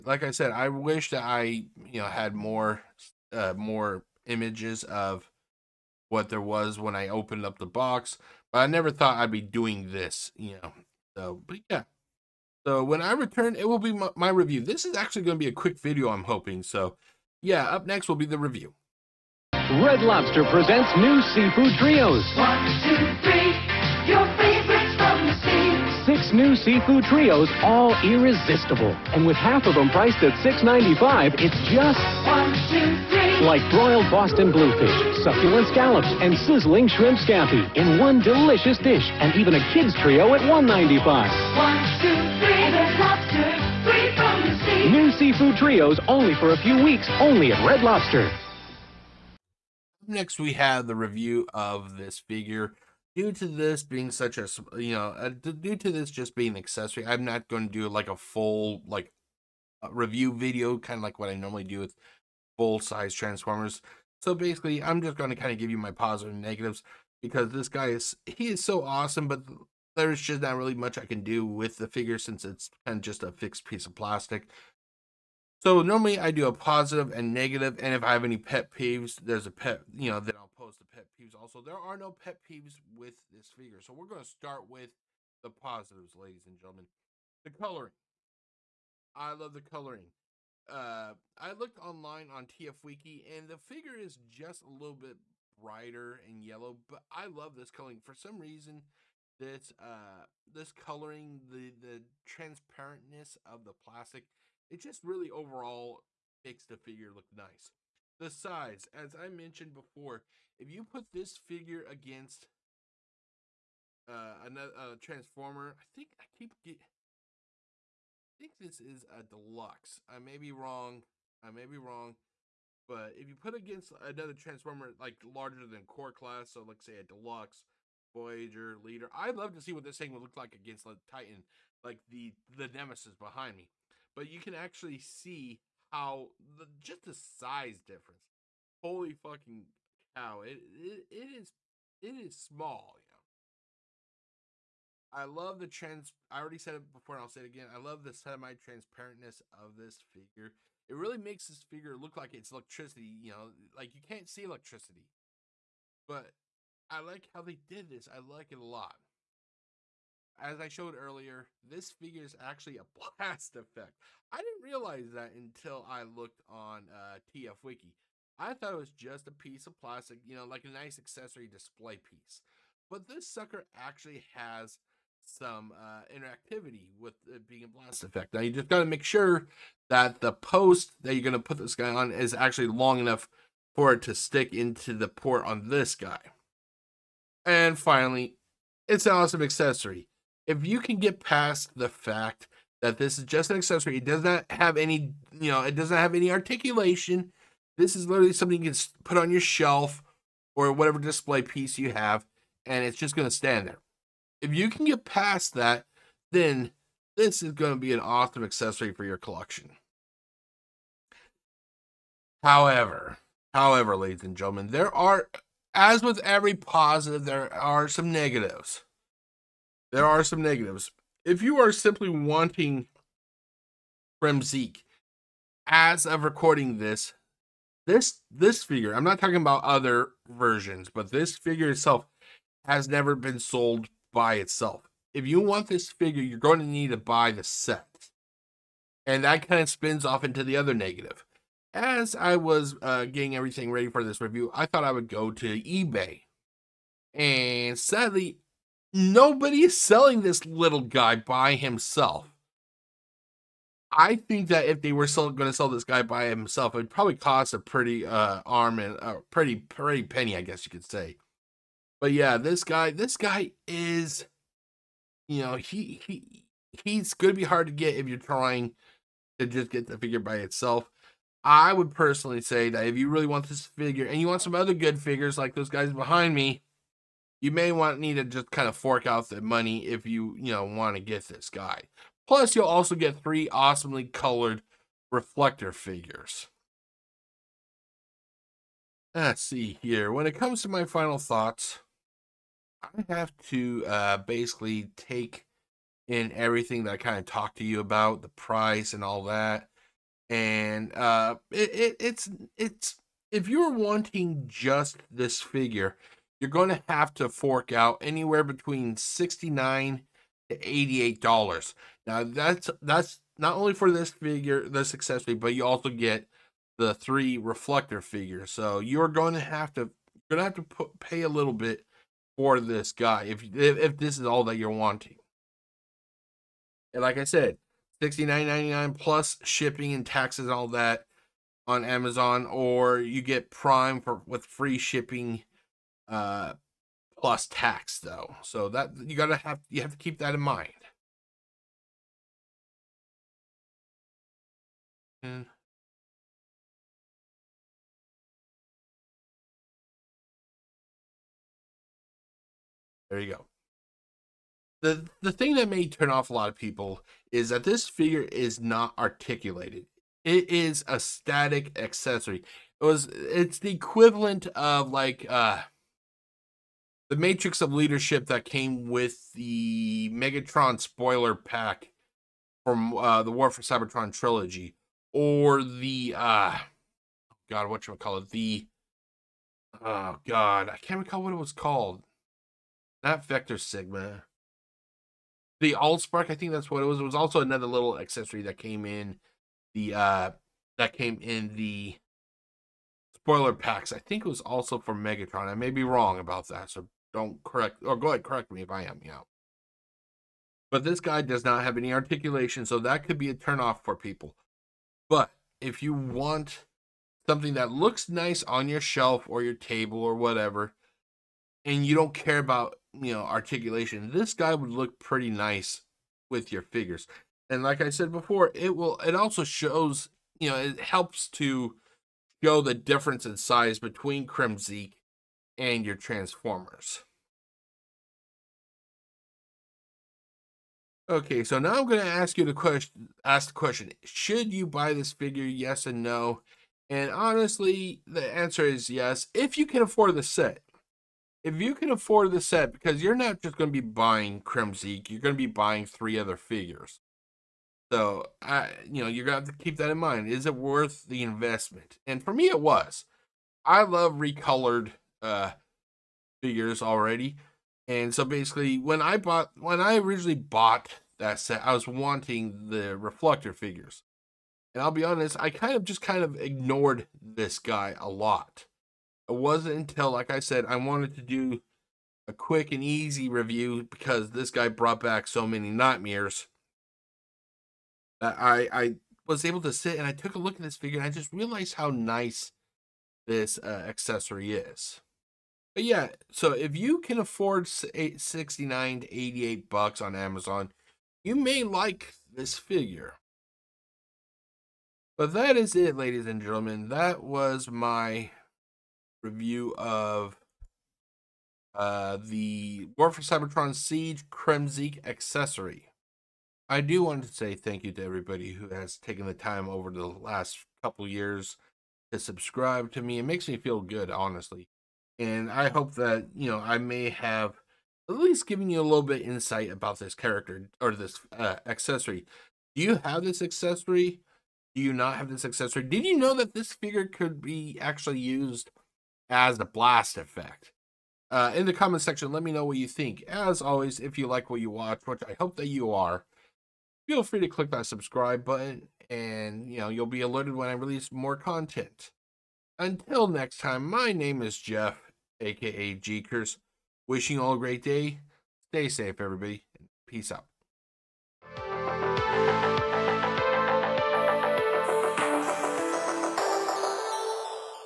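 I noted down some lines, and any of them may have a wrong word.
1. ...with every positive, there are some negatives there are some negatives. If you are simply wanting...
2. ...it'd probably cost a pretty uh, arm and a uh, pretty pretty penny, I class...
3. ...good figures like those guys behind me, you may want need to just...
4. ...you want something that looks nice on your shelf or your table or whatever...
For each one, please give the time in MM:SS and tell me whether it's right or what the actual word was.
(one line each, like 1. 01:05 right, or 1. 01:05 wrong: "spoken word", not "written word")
1. 03:36 right
2. 04:16 wrong: "guess", not "class"
3. 04:34 right
4. 06:45 right.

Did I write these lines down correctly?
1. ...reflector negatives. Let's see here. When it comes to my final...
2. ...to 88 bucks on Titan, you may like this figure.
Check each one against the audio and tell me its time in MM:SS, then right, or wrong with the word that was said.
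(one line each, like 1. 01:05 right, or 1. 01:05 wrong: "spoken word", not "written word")
1. 04:45 wrong: "figures", not "negatives"
2. 08:09 wrong: "Amazon", not "Titan".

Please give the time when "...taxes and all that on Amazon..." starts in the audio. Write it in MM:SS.
05:30.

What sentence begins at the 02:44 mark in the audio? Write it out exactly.
I didn't realize that until I looked on uh, TF Wiki.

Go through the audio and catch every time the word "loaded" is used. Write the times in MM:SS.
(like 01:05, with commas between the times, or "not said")
not said.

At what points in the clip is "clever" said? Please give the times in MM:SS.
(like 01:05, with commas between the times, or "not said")
not said.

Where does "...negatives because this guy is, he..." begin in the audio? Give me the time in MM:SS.
01:06.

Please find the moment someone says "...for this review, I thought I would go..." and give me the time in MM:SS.
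04:03.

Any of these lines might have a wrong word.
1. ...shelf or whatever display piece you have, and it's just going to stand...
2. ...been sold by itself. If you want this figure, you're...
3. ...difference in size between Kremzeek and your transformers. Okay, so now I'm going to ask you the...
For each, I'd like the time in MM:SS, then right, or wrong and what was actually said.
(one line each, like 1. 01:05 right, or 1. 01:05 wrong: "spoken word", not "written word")
1. 03:19 right
2. 03:53 right
3. 07:02 right.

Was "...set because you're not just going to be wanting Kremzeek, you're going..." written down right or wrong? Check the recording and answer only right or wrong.
wrong.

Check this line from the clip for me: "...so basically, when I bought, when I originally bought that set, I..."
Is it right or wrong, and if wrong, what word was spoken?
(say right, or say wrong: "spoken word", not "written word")
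right.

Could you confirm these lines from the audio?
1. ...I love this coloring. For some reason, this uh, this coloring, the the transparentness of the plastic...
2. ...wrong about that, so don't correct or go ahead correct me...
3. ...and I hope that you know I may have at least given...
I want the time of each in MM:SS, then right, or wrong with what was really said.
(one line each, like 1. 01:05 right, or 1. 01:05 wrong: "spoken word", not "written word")
1. 01:37 right
2. 06:35 right
3. 08:35 right.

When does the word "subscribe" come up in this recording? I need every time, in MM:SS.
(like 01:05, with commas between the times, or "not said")
08:32, 08:57.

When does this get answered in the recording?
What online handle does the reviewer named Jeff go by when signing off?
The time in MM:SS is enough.
09:05.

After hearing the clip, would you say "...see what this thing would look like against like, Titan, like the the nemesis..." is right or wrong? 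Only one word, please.
right.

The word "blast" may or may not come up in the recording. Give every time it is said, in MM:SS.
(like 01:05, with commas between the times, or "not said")
02:42, 02:57, 08:49.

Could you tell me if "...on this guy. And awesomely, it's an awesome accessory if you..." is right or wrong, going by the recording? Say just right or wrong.
wrong.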